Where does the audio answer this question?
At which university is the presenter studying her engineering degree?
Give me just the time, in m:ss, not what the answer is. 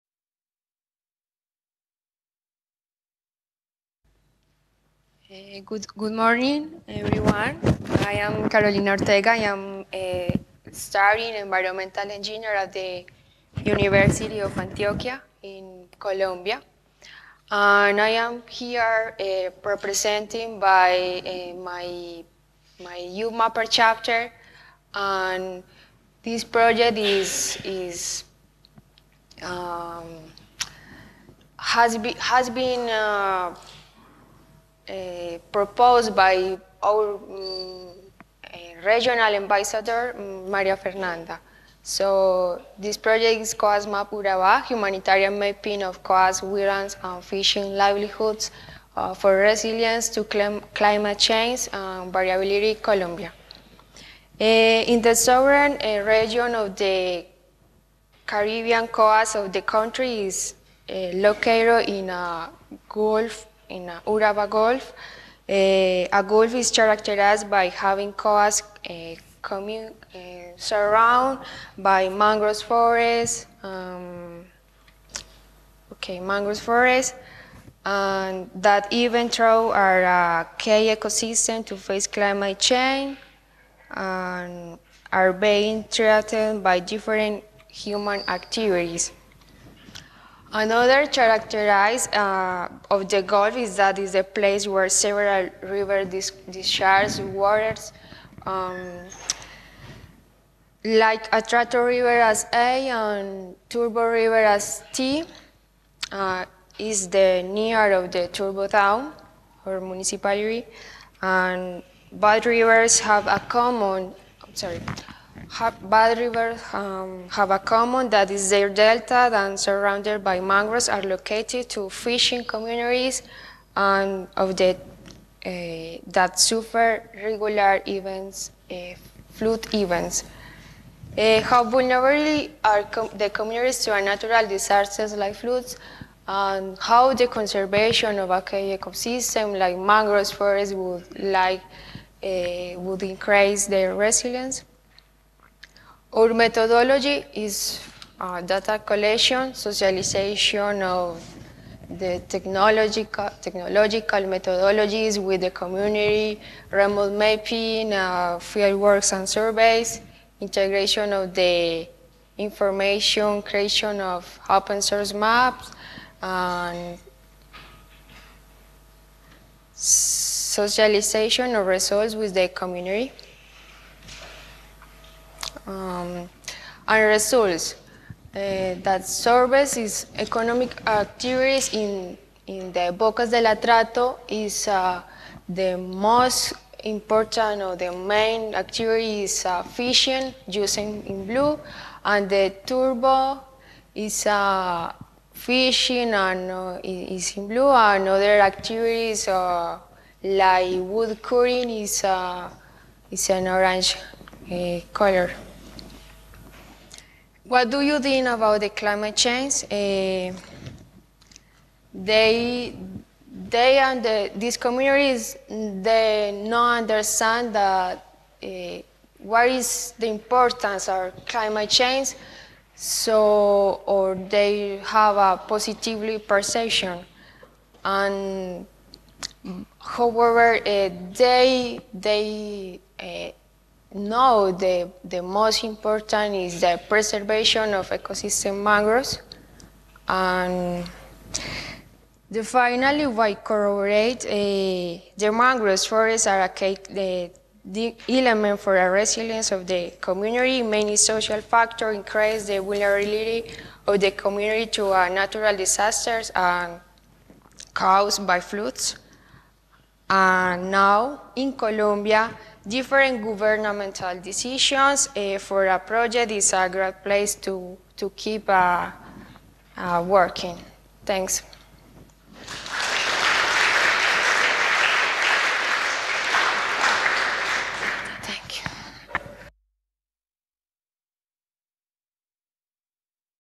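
0:13.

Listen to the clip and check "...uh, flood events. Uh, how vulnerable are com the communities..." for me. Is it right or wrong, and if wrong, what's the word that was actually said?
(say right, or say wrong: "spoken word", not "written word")
right.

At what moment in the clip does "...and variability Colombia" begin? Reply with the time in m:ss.
0:51.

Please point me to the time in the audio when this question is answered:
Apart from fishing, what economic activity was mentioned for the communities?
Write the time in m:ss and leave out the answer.
3:20.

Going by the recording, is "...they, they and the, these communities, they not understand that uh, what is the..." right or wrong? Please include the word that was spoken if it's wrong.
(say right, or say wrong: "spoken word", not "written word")
right.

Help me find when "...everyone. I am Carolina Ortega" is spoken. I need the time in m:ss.
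0:06.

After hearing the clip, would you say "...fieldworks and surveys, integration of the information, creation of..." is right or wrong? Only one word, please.
right.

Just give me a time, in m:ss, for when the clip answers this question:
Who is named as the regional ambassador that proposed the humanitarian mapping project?
0:40.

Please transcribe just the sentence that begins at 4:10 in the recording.
Many social factors increase the vulnerability of the community to uh, natural disasters and caused by floods.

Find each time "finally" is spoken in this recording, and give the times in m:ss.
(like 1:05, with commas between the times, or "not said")
4:02.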